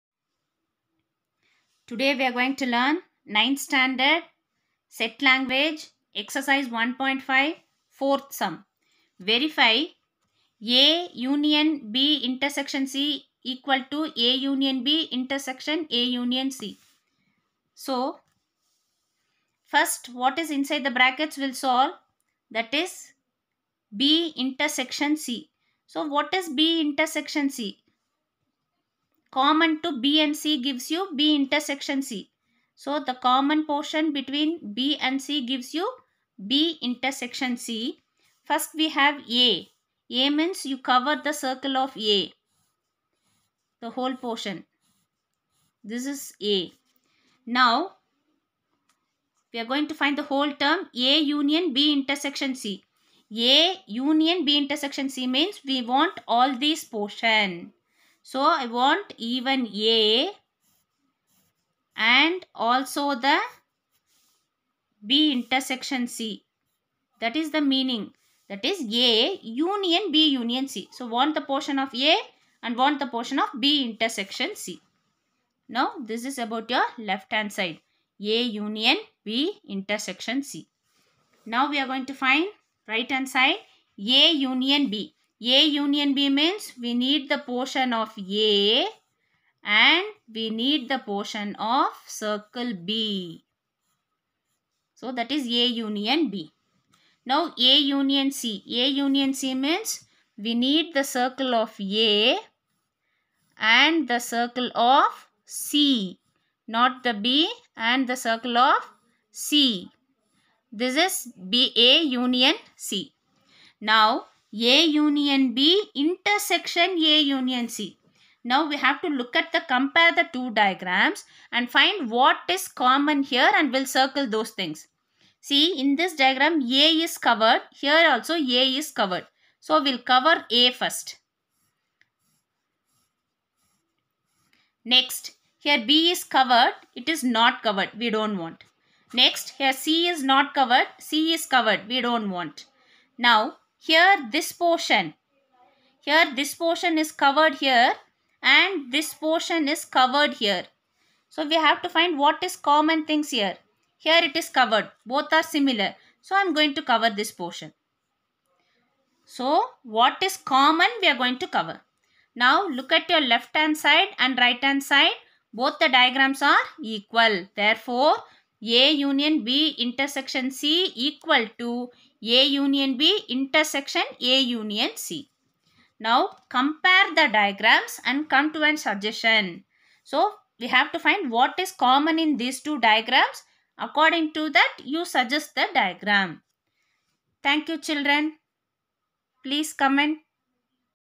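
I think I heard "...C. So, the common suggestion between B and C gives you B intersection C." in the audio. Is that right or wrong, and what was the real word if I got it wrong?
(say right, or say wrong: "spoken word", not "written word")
wrong: "portion", not "suggestion".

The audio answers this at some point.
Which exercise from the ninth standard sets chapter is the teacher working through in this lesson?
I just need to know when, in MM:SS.
00:06.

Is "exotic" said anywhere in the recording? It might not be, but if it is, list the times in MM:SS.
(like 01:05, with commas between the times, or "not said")
not said.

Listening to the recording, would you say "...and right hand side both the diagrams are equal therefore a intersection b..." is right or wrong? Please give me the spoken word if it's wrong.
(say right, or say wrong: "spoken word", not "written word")
wrong: "union", not "intersection".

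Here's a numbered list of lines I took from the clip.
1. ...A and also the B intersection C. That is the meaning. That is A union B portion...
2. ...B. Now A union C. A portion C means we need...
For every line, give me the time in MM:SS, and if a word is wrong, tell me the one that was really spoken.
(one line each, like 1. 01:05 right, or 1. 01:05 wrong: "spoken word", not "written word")
1. 00:59 wrong: "union", not "portion"
2. 01:36 wrong: "union", not "portion".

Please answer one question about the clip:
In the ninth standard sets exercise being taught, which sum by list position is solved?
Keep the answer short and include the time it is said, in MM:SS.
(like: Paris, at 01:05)
Fourth, at 00:07.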